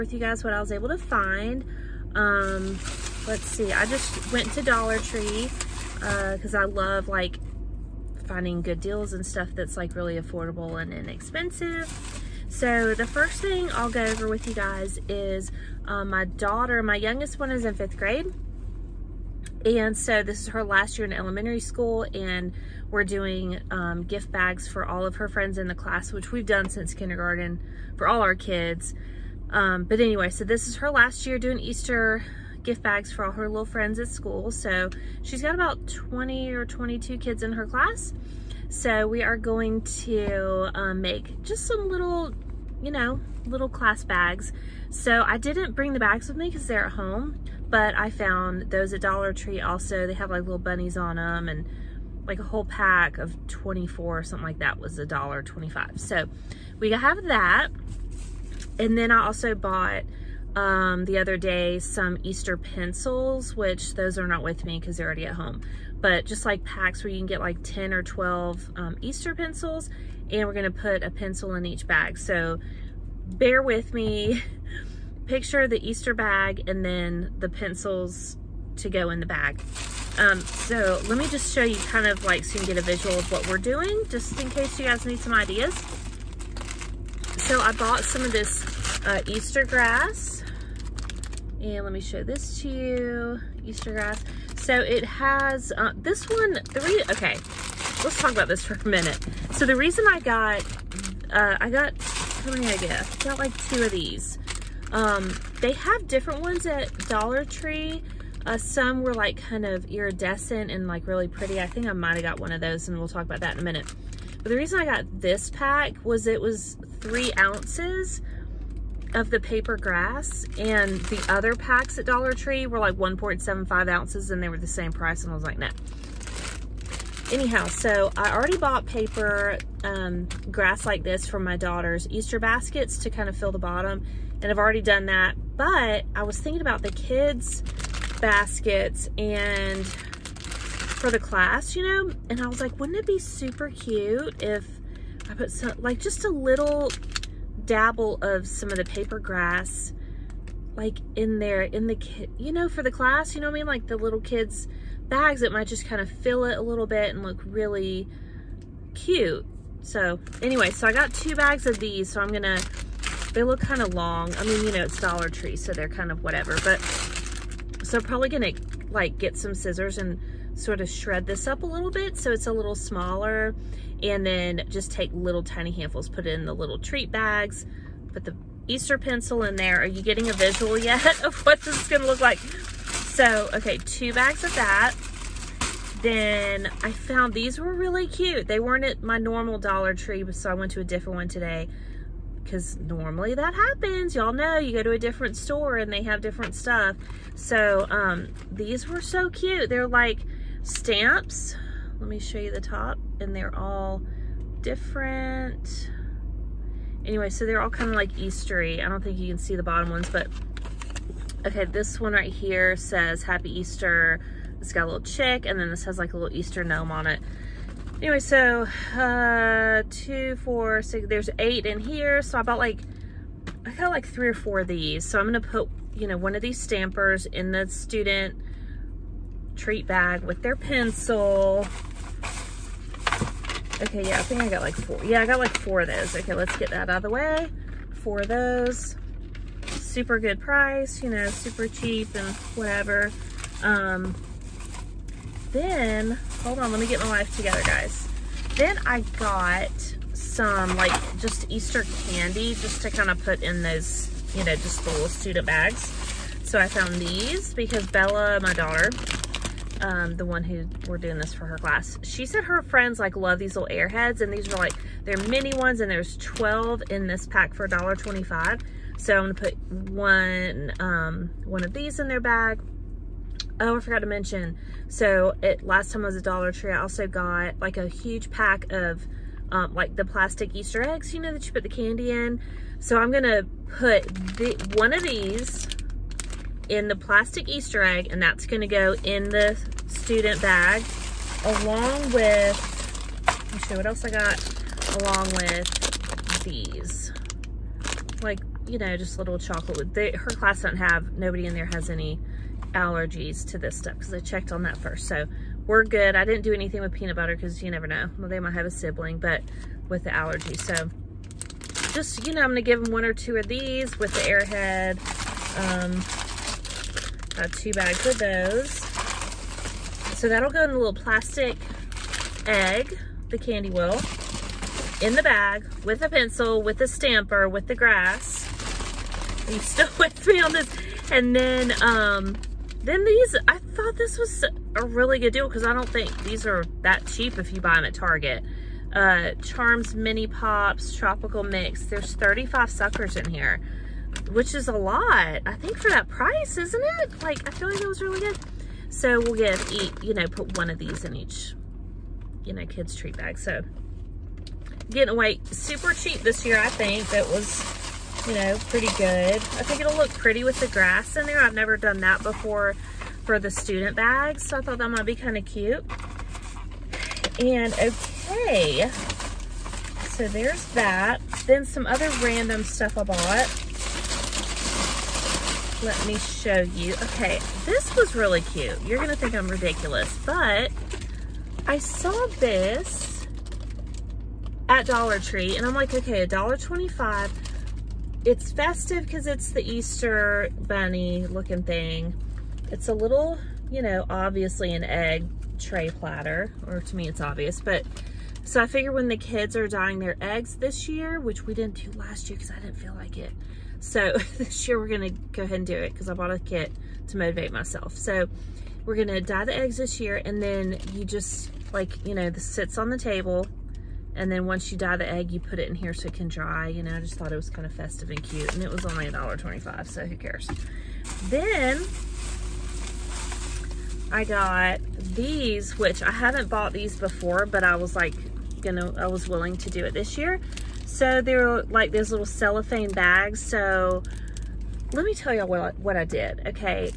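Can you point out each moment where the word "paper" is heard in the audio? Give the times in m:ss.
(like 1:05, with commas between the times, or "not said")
1:59, 2:08, 2:28.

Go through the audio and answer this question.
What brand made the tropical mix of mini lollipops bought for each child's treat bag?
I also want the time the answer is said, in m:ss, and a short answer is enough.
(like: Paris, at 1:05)
Charms, at 5:39.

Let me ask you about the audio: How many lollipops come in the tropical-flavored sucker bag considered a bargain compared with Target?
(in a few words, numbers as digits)
35.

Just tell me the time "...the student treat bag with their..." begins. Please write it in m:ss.
3:47.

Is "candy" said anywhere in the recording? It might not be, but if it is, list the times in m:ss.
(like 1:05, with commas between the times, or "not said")
4:12, 4:41, 5:23.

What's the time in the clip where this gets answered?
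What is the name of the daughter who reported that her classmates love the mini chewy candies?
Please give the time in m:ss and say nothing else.
4:17.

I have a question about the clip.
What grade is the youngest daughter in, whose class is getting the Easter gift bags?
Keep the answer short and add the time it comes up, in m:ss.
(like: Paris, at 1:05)
Fifth grade, at 0:17.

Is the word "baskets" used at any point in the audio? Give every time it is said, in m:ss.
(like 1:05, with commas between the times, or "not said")
2:12, 2:18.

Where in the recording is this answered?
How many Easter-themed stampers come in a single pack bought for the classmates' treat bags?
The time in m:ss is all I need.
3:41.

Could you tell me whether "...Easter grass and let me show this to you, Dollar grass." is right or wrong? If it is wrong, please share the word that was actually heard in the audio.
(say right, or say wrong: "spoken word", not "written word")
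wrong: "Easter", not "Dollar".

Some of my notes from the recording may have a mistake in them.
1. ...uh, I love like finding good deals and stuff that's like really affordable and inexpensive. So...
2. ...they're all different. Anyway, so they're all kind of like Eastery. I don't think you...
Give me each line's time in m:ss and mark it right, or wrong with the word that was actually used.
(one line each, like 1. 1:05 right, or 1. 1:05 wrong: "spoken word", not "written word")
1. 0:06 right
2. 3:23 right.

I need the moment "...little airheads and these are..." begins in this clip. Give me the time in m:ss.
4:23.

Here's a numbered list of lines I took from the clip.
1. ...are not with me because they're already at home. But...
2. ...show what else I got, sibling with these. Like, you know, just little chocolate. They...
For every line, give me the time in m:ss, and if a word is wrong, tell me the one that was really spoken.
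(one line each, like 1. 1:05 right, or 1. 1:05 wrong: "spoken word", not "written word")
1. 1:04 right
2. 4:53 wrong: "along", not "sibling".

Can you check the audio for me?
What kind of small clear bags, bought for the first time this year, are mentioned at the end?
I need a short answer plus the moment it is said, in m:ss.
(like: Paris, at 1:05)
Cellophane bags, at 7:12.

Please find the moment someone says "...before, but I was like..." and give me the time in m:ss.
7:06.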